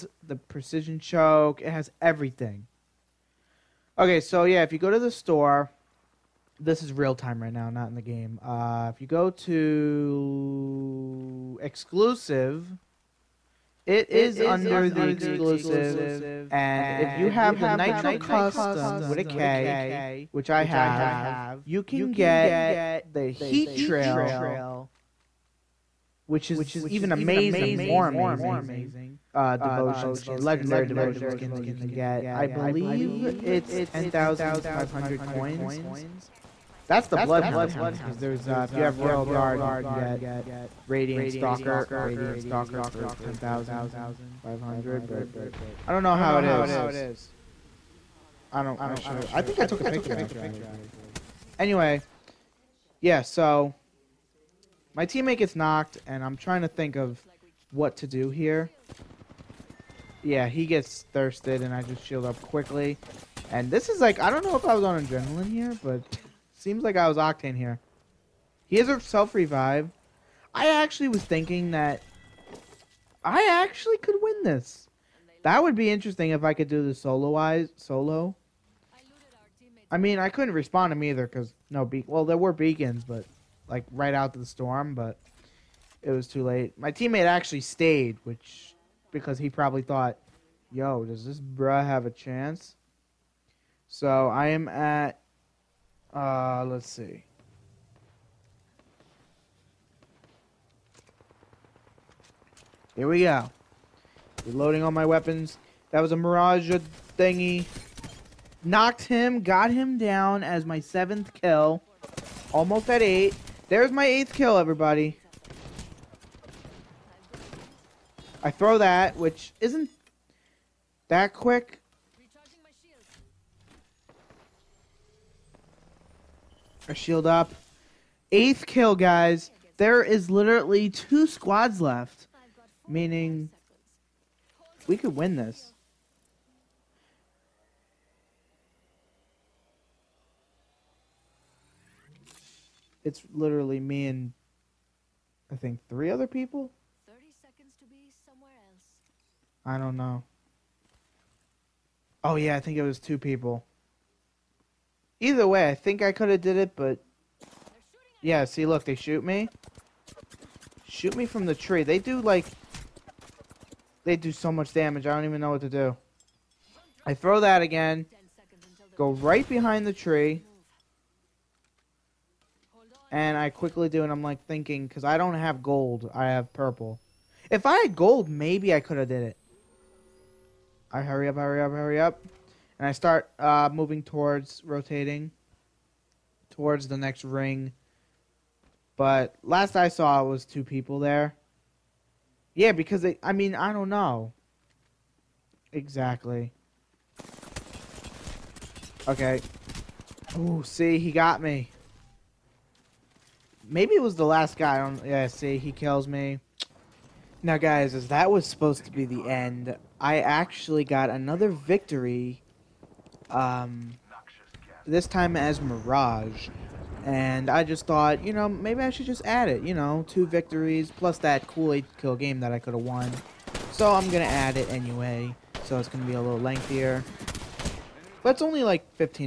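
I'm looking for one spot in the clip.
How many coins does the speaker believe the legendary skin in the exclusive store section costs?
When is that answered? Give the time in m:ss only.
0:33.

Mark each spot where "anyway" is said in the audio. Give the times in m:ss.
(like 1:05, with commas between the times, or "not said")
0:51, 3:44.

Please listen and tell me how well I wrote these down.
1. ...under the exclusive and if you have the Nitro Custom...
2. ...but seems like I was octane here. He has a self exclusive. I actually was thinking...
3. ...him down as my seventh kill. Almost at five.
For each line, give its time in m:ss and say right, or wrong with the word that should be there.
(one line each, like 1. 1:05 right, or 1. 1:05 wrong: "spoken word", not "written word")
1. 0:14 right
2. 1:05 wrong: "revive", not "exclusive"
3. 1:49 wrong: "eight", not "five".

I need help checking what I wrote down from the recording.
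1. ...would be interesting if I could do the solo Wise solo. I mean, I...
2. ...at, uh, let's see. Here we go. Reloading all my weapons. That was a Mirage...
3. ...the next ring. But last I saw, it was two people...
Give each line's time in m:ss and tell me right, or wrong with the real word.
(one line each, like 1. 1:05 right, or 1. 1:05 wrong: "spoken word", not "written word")
1. 1:15 right
2. 1:34 right
3. 3:06 right.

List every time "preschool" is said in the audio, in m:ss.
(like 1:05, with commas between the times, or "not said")
not said.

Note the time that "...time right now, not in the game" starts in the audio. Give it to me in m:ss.
0:07.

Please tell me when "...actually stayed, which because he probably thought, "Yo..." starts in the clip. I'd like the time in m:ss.
1:27.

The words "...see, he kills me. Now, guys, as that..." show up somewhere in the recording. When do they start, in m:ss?
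3:25.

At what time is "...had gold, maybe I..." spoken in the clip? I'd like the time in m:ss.
2:57.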